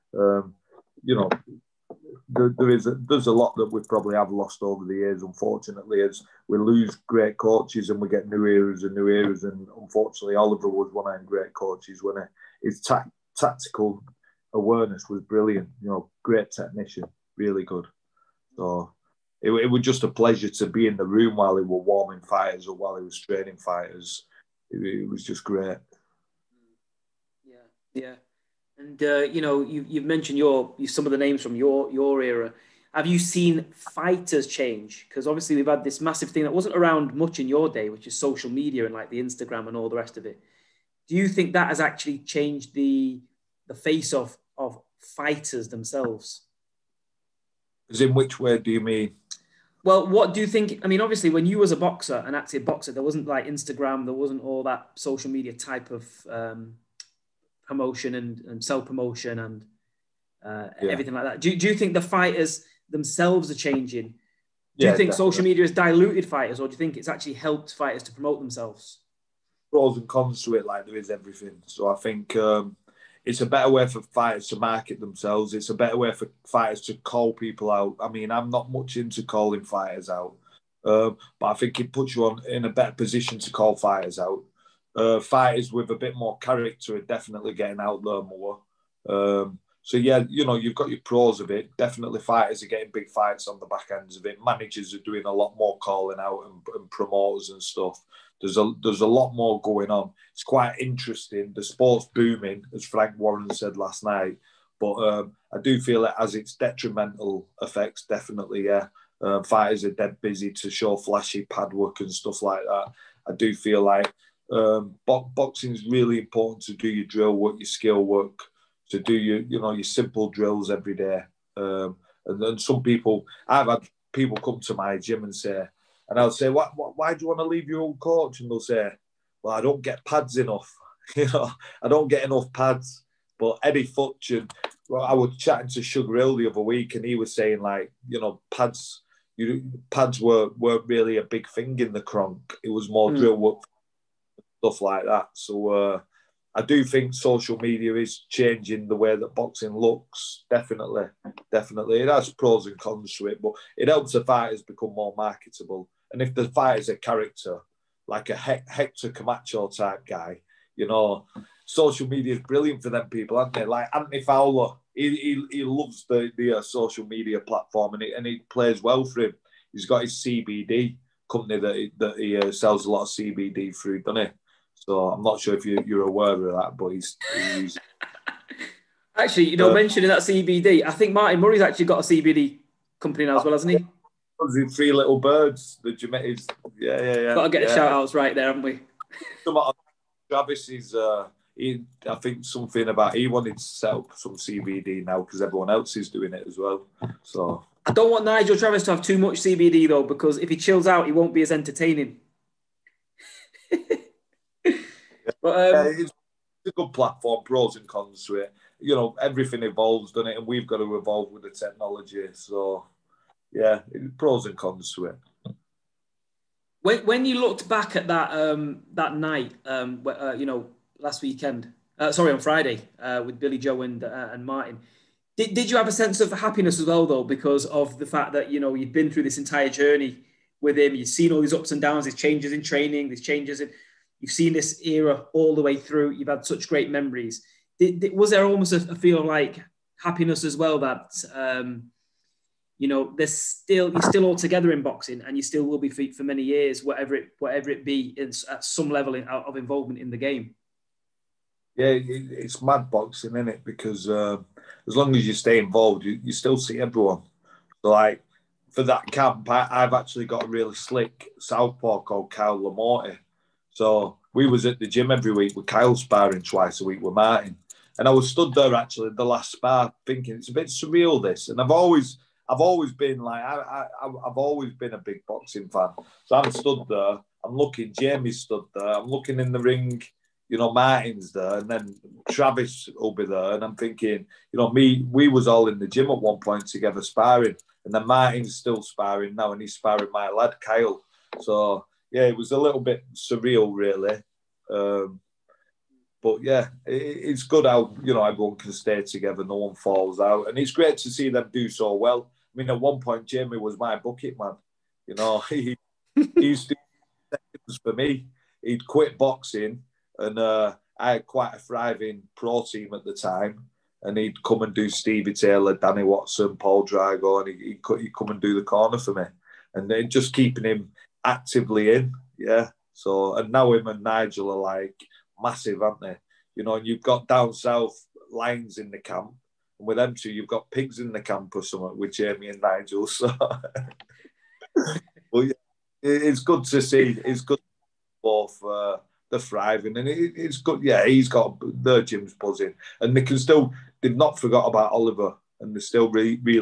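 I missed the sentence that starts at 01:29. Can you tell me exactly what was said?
Um, so yeah, you know, you've got your pros of it.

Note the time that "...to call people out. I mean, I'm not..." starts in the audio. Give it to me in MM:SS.
01:16.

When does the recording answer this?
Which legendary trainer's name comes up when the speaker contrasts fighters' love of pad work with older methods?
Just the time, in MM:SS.
02:13.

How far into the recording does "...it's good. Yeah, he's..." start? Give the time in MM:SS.
05:40.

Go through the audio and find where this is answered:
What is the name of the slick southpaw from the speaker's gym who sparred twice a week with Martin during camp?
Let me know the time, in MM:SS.
04:22.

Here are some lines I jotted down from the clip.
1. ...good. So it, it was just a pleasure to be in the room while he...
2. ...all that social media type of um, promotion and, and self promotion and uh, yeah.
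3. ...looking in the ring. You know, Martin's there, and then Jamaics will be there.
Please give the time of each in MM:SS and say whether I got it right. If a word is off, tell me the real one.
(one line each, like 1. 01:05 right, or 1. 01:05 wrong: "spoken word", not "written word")
1. 00:17 right
2. 00:54 right
3. 04:39 wrong: "Travis", not "Jamaics".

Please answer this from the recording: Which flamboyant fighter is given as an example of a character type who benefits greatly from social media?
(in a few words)
Hector Camacho.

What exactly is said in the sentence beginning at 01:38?
There's a there's a lot more going on.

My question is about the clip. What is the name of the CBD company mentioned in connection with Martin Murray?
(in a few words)
Three Little Birds.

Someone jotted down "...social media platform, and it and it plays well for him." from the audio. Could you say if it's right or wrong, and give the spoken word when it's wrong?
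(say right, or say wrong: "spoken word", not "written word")
right.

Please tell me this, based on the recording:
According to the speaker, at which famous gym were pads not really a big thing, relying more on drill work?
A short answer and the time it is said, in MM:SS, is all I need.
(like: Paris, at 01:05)
the Kronk, at 02:21.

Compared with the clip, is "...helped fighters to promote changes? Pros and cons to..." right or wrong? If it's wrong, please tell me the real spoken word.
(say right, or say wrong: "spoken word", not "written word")
wrong: "themselves", not "changes".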